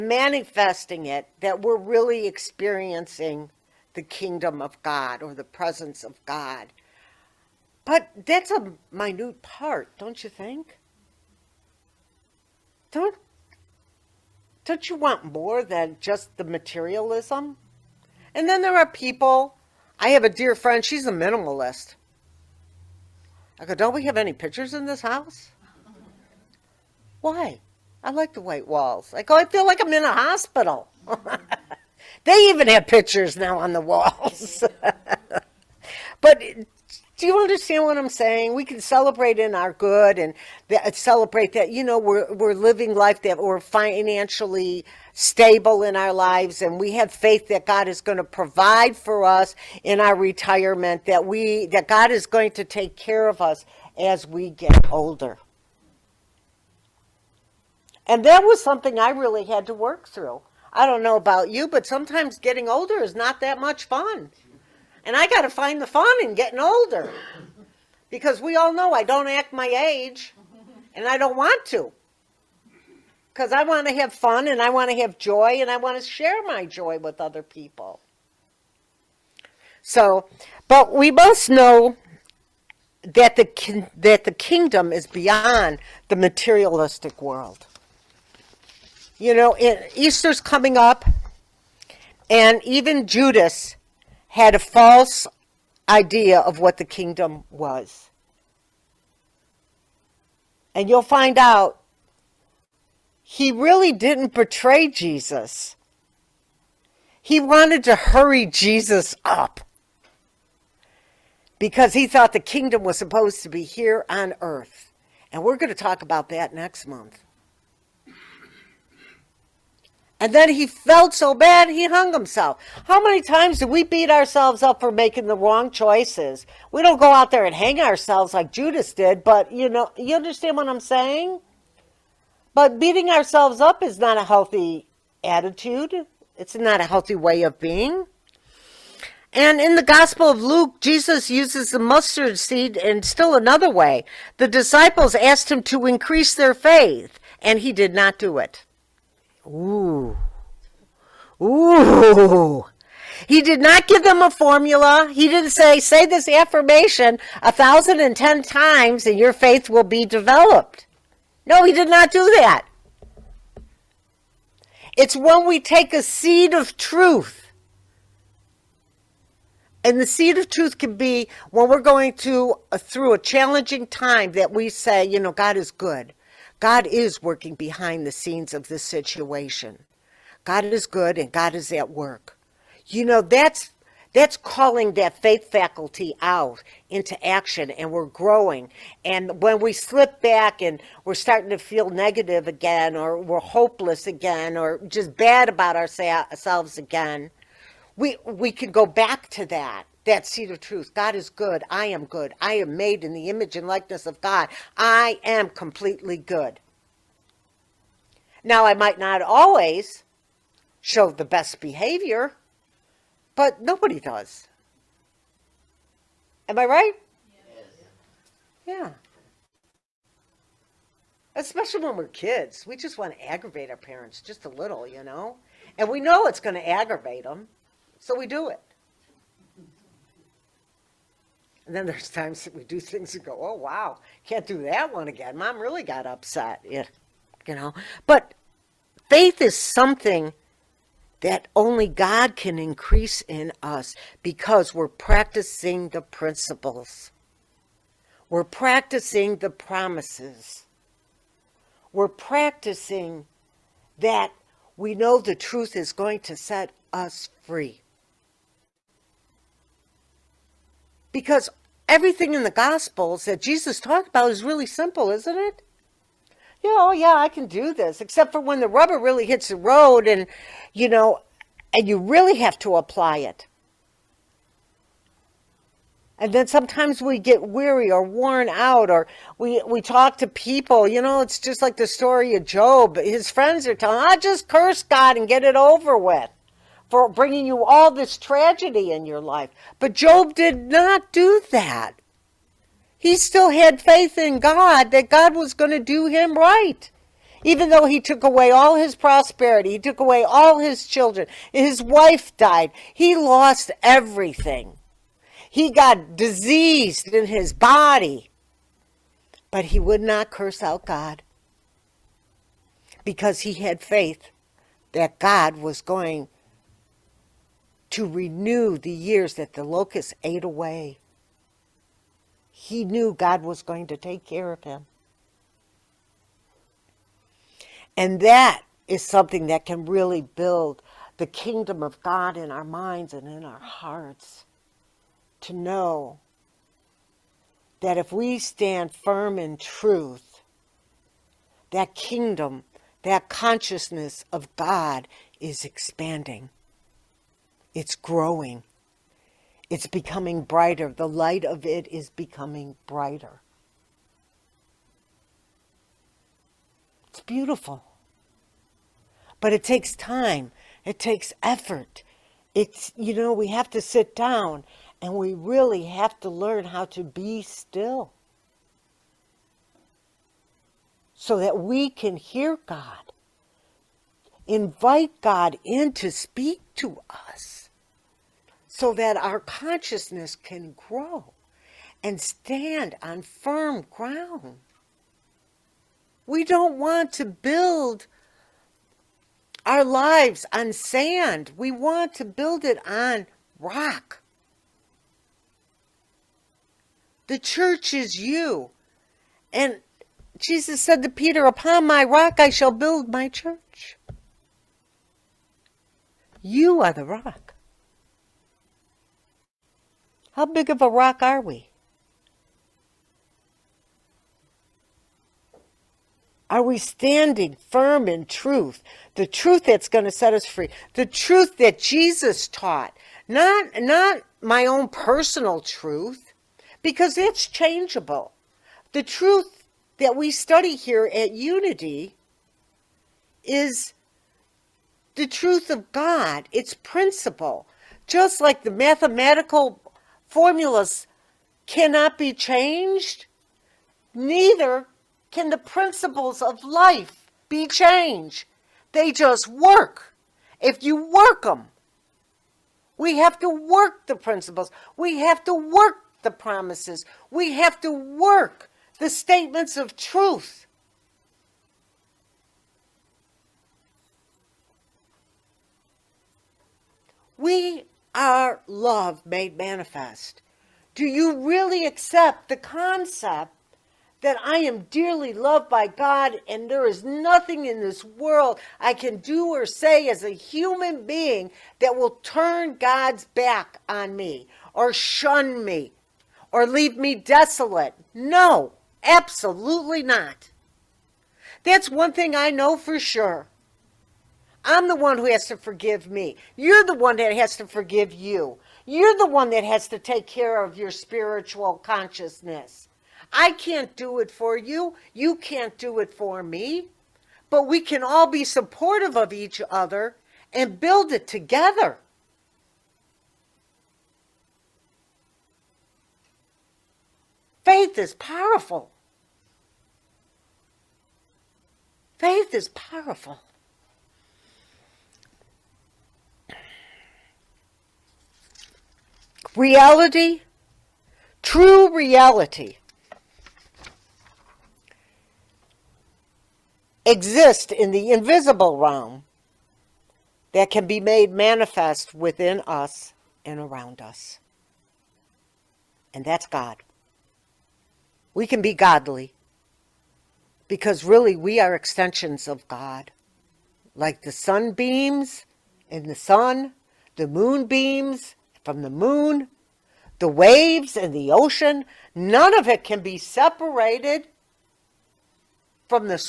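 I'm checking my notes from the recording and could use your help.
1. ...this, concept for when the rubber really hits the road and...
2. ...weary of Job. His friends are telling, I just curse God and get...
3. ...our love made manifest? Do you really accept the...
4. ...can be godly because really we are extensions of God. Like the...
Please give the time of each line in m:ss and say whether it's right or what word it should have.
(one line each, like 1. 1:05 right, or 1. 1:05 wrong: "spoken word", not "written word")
1. 4:27 wrong: "except", not "concept"
2. 4:41 wrong: "story", not "weary"
3. 7:48 right
4. 9:08 right.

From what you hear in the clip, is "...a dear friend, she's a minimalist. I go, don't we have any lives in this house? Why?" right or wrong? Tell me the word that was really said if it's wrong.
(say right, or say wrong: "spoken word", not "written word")
wrong: "pictures", not "lives".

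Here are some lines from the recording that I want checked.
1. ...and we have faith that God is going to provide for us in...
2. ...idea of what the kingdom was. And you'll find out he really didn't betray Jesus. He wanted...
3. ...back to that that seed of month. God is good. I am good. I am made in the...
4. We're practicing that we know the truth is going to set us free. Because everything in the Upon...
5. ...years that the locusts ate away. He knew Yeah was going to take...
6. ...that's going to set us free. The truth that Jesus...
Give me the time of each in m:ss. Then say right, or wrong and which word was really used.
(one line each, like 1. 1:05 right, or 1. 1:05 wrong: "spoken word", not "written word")
1. 0:46 right
2. 1:35 right
3. 3:18 wrong: "truth", not "month"
4. 4:11 wrong: "Gospels", not "Upon"
5. 5:18 wrong: "God", not "Yeah"
6. 6:59 right.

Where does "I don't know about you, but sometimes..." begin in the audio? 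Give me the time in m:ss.
1:00.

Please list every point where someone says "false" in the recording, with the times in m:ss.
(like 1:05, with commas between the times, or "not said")
1:34.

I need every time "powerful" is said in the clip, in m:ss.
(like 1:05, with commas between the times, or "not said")
8:38, 8:42.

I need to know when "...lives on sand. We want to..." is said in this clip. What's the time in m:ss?
6:29.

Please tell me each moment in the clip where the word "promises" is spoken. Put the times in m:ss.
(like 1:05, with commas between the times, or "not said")
4:09, 7:36.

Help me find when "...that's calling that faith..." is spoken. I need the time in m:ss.
3:04.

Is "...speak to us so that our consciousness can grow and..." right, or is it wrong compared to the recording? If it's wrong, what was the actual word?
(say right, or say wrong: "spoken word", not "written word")
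right.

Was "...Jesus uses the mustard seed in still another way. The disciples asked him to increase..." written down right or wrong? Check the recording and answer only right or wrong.
right.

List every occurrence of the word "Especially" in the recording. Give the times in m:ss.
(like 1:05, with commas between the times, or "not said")
3:41.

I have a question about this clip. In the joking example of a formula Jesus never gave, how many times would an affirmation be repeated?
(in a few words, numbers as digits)
1010.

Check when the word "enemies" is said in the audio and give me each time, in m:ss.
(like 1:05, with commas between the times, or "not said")
not said.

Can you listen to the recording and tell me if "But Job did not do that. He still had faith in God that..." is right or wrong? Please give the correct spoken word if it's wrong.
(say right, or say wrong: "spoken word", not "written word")
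right.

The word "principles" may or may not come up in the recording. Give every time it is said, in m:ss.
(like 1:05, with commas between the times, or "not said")
4:06, 7:16, 7:25, 7:34.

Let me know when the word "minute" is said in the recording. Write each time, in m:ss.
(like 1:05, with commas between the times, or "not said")
0:08.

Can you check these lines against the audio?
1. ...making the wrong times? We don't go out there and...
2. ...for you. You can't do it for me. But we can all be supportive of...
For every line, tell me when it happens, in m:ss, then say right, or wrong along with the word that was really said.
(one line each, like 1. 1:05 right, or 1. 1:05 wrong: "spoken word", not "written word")
1. 2:04 wrong: "choices", not "times"
2. 8:24 right.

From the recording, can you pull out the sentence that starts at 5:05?
He got diseased in his body.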